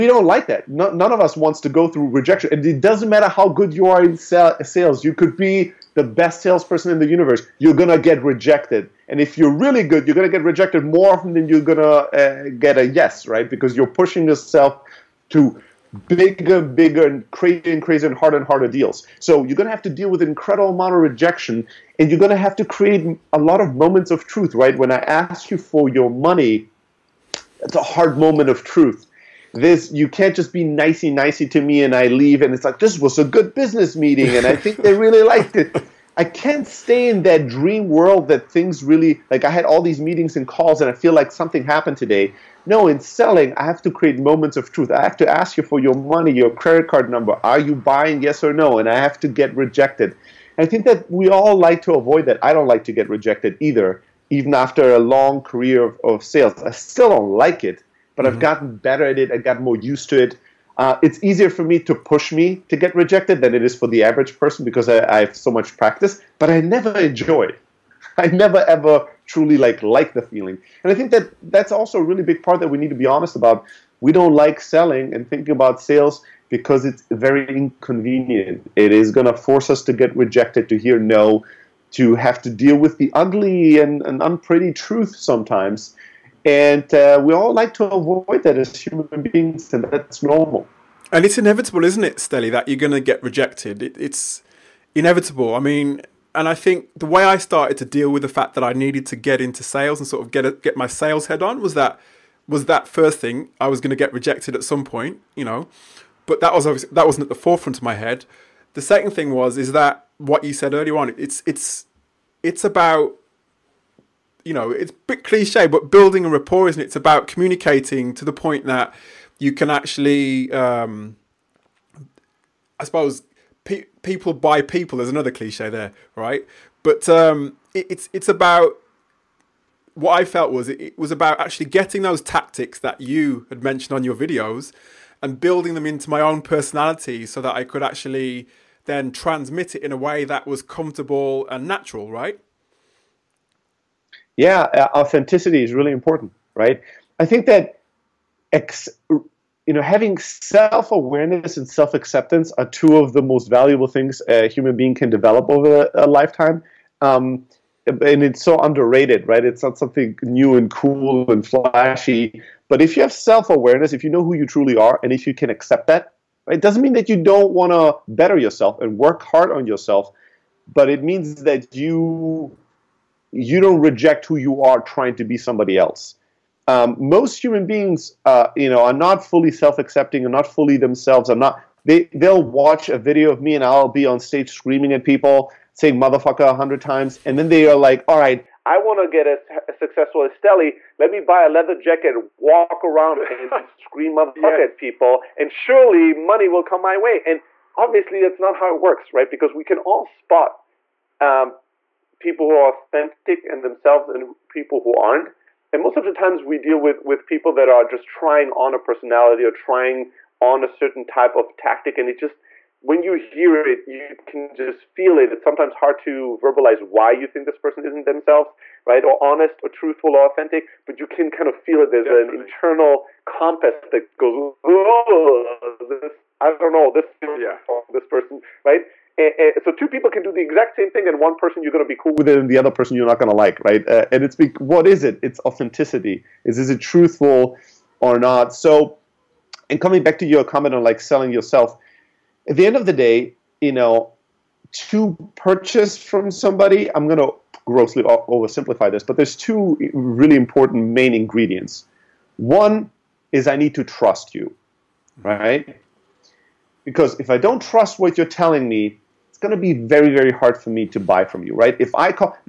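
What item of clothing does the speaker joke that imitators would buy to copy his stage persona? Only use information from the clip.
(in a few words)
leather jacket.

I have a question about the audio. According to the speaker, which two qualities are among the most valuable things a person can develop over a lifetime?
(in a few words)
self awareness and self acceptance.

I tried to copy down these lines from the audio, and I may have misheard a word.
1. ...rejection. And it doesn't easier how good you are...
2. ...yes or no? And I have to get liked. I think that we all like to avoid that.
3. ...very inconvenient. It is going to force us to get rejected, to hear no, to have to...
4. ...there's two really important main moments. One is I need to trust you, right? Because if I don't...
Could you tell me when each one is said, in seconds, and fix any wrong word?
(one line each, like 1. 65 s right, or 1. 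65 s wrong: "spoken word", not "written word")
1. 2 s wrong: "matter", not "easier"
2. 48 s wrong: "rejected", not "liked"
3. 77 s right
4. 249 s wrong: "ingredients", not "moments".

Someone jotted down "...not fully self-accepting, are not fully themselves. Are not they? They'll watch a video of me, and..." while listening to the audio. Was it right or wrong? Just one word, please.
right.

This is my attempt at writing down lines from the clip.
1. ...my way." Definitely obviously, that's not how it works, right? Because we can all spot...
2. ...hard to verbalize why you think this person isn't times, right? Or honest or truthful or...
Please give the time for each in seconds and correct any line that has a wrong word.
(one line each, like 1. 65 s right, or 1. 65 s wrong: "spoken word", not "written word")
1. 196 s wrong: "And", not "Definitely"
2. 215 s wrong: "themselves", not "times".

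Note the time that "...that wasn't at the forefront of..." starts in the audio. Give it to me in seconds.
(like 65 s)
106 s.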